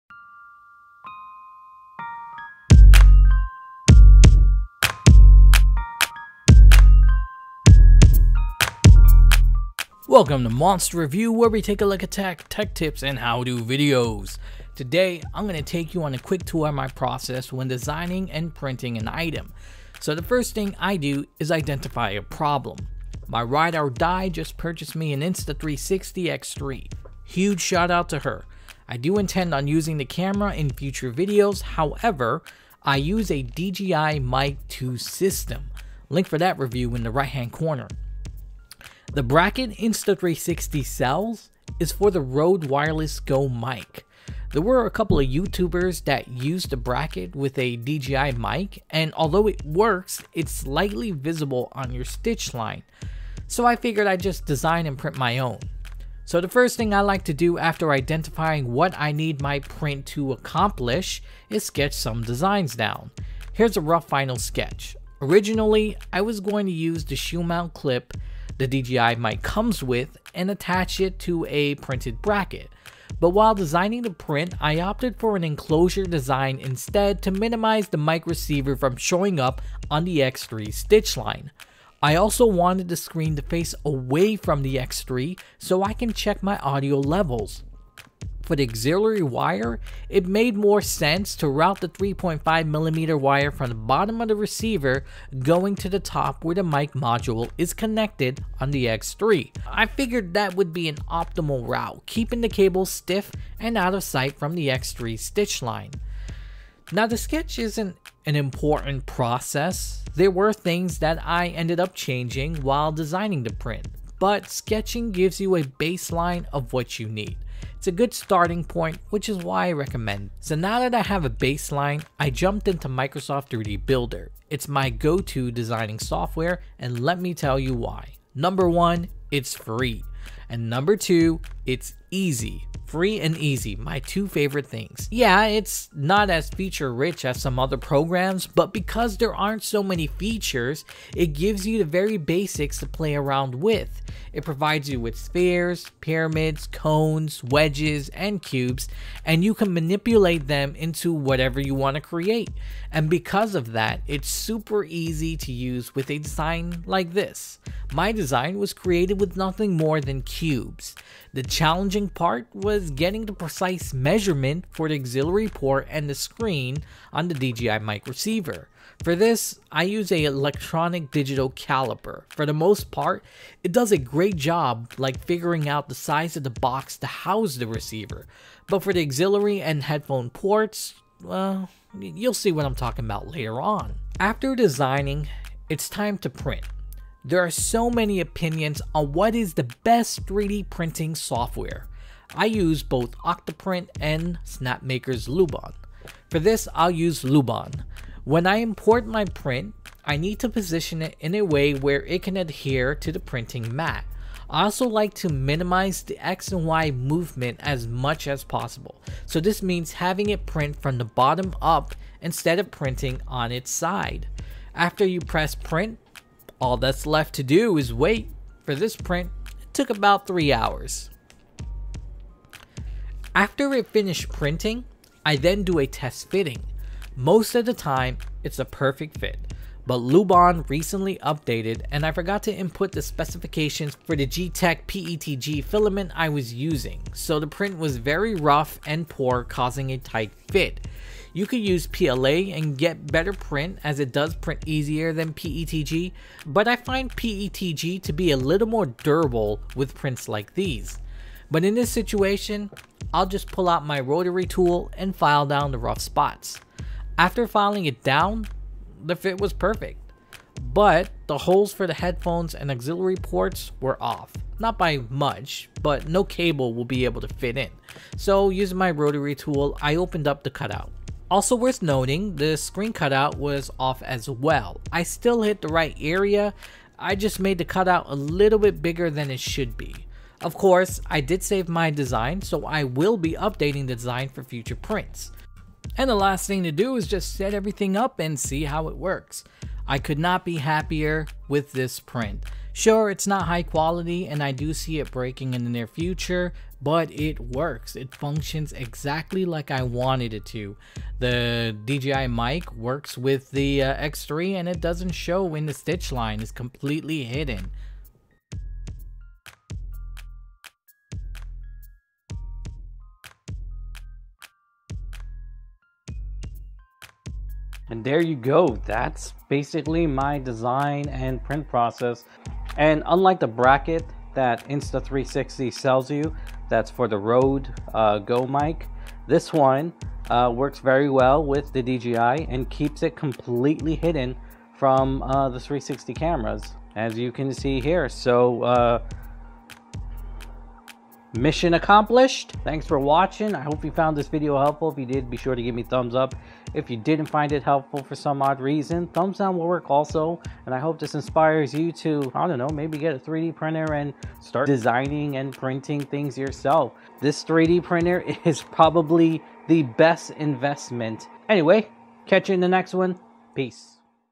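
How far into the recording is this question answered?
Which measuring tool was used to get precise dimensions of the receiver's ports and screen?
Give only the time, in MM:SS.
02:50.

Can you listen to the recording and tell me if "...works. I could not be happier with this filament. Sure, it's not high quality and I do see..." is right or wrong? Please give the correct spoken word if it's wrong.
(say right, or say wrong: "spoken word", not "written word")
wrong: "print", not "filament".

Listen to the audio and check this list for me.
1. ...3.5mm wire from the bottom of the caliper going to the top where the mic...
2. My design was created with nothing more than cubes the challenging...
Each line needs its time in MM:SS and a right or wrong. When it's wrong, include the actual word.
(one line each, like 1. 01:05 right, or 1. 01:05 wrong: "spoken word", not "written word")
1. 01:31 wrong: "receiver", not "caliper"
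2. 02:37 right.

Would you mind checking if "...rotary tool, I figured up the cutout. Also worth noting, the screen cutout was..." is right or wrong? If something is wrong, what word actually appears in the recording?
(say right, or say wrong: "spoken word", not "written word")
wrong: "opened", not "figured".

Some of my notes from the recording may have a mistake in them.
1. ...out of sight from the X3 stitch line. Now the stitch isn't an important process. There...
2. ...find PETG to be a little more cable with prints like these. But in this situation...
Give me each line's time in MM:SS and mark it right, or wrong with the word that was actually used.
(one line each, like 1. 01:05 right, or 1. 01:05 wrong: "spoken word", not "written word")
1. 01:43 wrong: "sketch", not "stitch"
2. 04:06 wrong: "durable", not "cable".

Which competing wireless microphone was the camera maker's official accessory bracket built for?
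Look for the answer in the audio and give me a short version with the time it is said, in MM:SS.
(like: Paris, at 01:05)
Rode Wireless Go, at 00:42.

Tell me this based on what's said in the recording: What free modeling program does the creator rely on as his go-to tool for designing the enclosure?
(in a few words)
Microsoft 3D Builder.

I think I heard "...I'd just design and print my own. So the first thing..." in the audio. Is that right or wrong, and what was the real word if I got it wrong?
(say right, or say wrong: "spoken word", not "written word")
right.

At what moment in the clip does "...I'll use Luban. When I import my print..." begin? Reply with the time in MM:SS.
03:16.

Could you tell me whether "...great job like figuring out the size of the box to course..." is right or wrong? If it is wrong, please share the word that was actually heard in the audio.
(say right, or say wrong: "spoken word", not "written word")
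wrong: "house", not "course".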